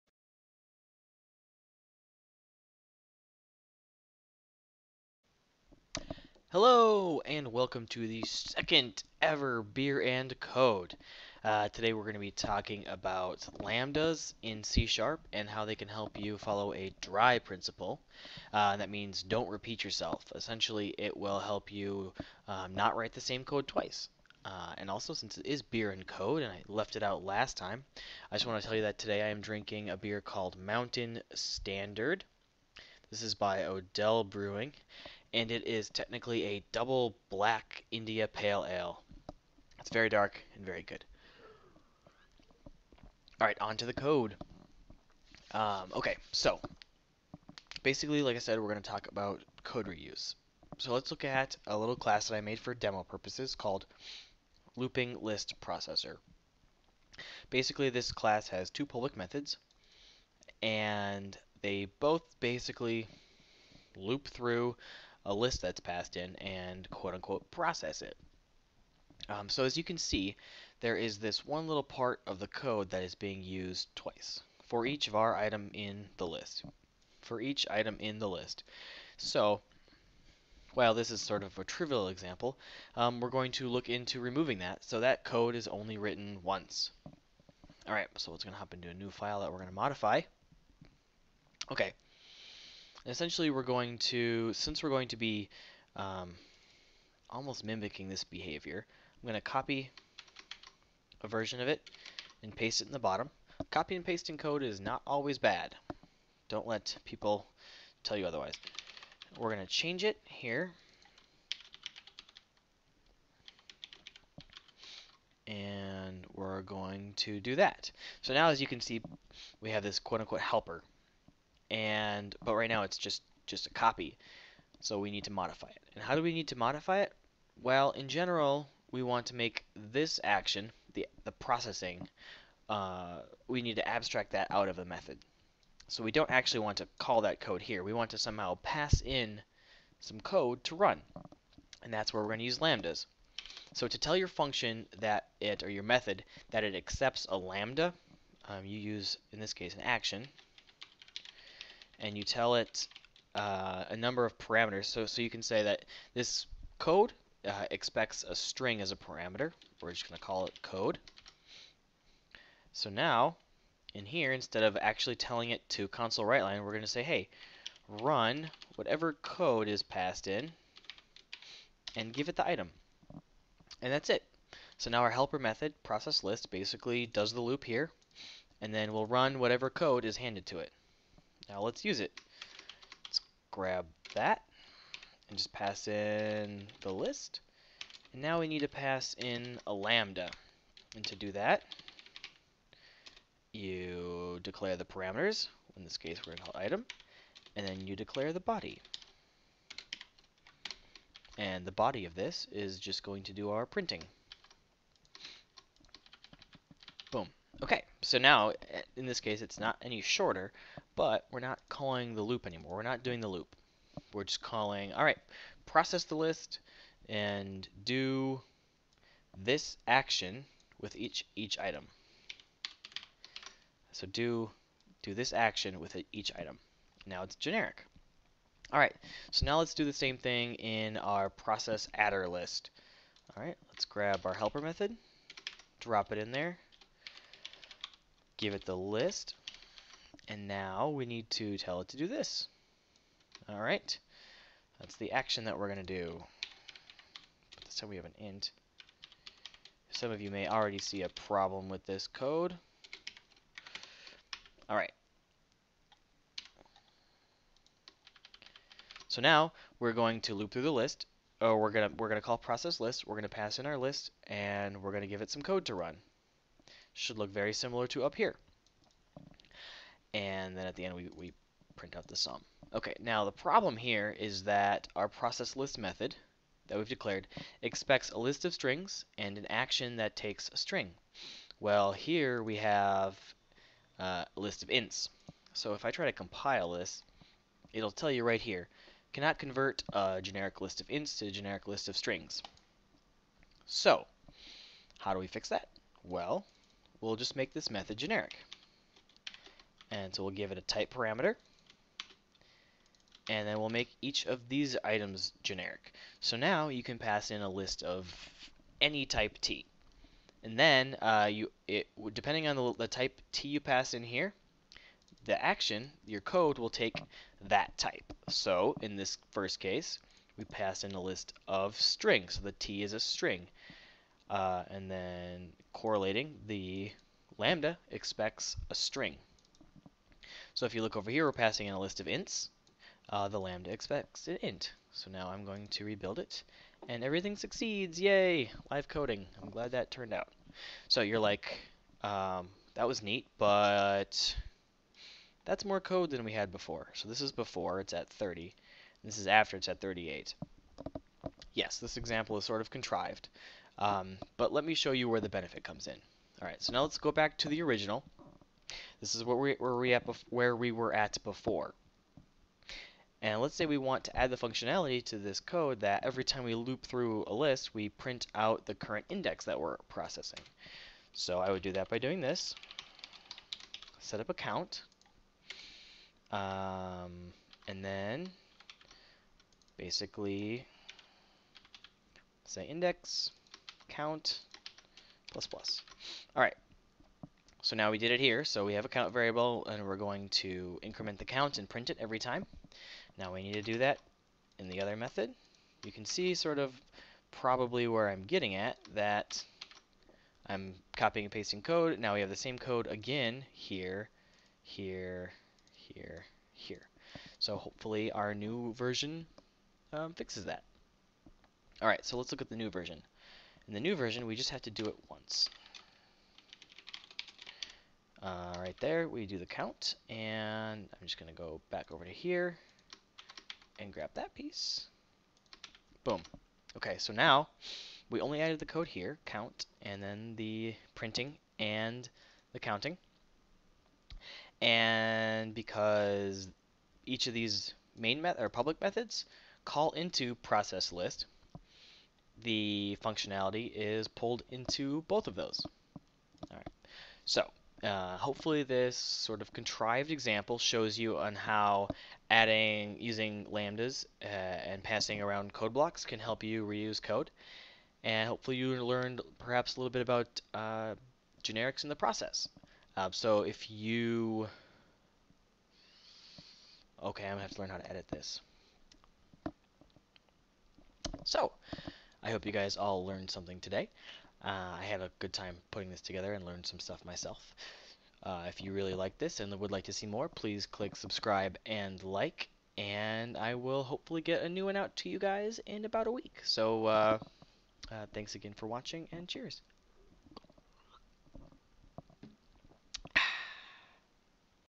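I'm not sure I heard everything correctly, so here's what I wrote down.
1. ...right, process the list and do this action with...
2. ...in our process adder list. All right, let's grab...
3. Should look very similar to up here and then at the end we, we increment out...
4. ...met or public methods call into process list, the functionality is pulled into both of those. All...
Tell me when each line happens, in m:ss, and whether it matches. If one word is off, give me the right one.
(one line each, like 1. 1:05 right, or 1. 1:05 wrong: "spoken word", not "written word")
1. 3:35 right
2. 3:50 right
3. 4:26 wrong: "print", not "increment"
4. 7:18 right.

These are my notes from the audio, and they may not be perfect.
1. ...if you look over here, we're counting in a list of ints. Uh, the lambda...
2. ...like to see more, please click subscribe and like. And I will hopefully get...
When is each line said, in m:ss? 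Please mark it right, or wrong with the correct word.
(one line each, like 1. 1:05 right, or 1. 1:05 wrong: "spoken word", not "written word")
1. 5:30 wrong: "passing", not "counting"
2. 7:59 right.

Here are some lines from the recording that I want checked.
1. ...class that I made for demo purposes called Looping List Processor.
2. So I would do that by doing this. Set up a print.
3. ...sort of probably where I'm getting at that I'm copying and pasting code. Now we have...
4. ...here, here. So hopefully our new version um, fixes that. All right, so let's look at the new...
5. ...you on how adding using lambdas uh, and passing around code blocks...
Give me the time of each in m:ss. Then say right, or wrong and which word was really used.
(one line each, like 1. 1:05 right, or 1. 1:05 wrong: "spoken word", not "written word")
1. 0:51 right
2. 6:11 wrong: "count", not "print"
3. 6:36 right
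4. 6:45 right
5. 7:30 right.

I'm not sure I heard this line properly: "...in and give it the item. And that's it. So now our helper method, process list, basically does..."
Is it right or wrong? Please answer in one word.
right.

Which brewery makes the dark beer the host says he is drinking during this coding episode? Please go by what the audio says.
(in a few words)
Odell Brewing.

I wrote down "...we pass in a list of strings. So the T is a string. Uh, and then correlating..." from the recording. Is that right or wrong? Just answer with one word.
right.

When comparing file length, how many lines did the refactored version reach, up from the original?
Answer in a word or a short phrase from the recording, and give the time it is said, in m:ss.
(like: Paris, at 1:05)
38, at 5:49.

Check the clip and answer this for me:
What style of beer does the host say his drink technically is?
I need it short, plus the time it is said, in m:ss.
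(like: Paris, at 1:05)
double black India Pale Ale, at 0:36.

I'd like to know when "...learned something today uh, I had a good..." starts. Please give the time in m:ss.
7:53.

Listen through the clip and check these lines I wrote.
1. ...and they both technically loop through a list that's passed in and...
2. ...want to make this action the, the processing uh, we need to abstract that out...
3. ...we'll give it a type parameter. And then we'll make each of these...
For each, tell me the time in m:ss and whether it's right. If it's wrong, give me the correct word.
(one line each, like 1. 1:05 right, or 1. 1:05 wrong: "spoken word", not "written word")
1. 1:00 wrong: "basically", not "technically"
2. 2:09 right
3. 5:00 right.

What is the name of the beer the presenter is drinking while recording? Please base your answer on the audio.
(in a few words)
Mountain Standard.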